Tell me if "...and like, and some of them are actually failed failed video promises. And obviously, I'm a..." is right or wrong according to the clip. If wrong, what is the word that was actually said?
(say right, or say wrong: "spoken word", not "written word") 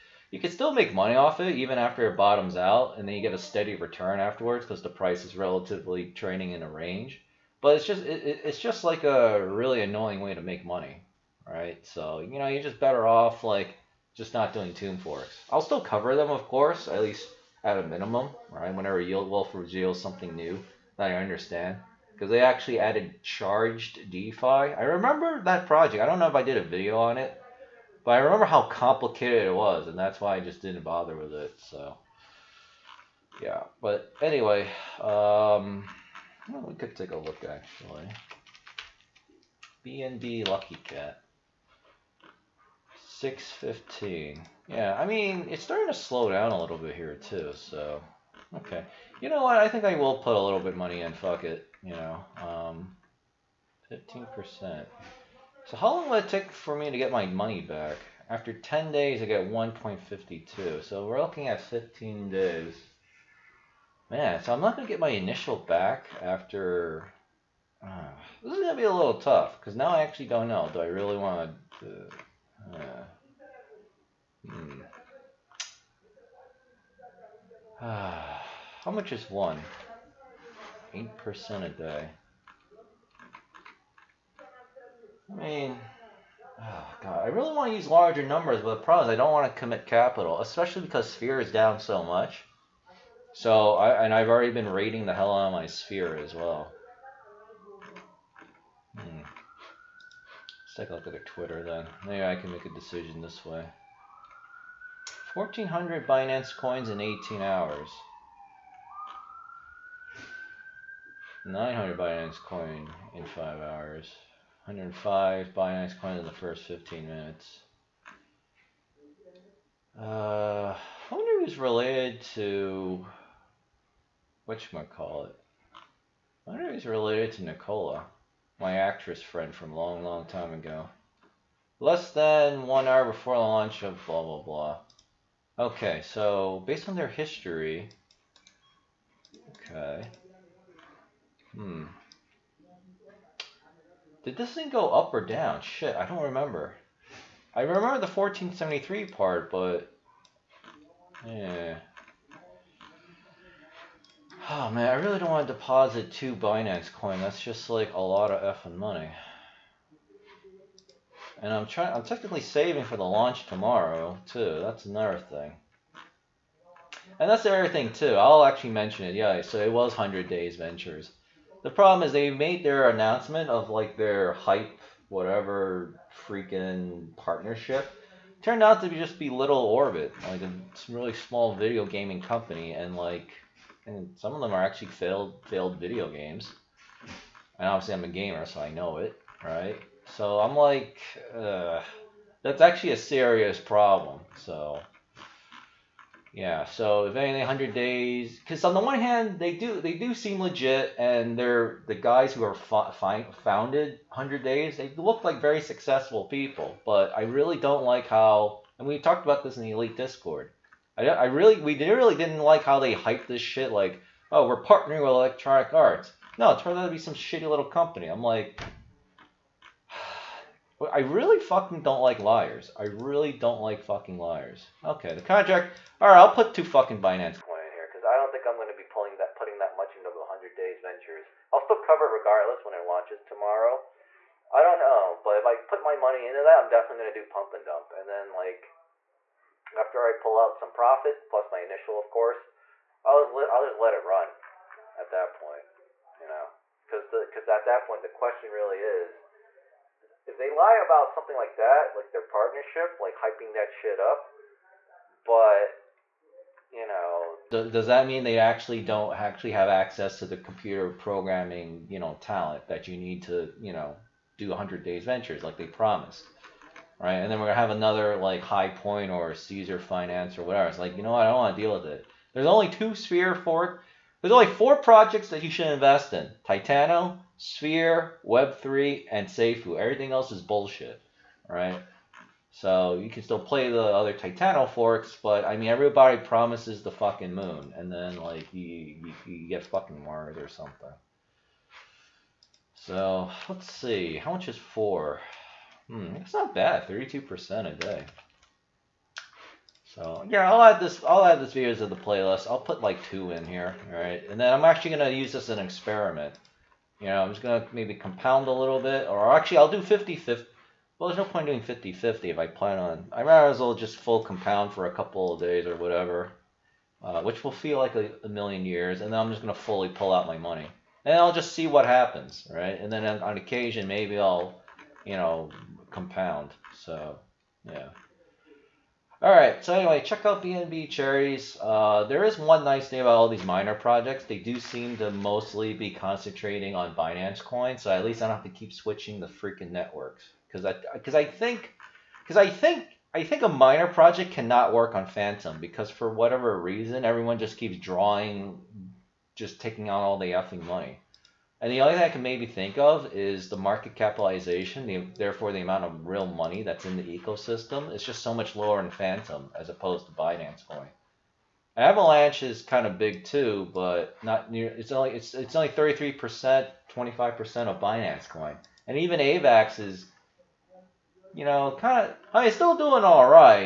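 wrong: "games", not "promises".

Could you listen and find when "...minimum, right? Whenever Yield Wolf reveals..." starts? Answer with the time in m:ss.
0:17.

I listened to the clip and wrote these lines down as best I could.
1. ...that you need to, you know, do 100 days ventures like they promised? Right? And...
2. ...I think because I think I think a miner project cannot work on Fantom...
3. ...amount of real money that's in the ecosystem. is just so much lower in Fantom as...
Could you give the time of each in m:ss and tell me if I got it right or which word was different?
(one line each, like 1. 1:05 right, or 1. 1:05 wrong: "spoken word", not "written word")
1. 4:22 right
2. 5:41 right
3. 5:55 right.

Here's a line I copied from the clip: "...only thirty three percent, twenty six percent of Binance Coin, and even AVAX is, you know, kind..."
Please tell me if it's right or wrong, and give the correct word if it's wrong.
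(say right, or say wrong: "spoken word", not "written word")
wrong: "five", not "six".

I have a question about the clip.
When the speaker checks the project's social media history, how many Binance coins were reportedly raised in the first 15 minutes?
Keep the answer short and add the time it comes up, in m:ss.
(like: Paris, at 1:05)
105, at 1:54.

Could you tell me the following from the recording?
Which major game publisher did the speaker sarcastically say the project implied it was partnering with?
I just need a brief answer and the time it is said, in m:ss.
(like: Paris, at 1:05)
Electronic Arts, at 3:35.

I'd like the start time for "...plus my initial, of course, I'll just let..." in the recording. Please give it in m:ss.
4:01.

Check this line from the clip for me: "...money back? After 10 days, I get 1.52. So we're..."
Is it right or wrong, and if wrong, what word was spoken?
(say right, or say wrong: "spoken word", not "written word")
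right.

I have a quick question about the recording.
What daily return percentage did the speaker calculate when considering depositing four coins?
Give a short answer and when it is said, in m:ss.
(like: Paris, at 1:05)
32%, at 4:56.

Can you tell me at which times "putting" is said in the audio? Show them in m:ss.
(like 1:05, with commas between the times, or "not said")
3:49.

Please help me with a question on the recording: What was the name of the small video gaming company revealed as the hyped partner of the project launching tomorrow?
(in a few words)
Little Orbit.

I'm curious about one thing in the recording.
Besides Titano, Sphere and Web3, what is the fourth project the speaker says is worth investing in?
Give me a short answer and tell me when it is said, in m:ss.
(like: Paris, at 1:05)
Safuu, at 4:39.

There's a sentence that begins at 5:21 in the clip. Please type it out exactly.
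And I'll just see what happens, right?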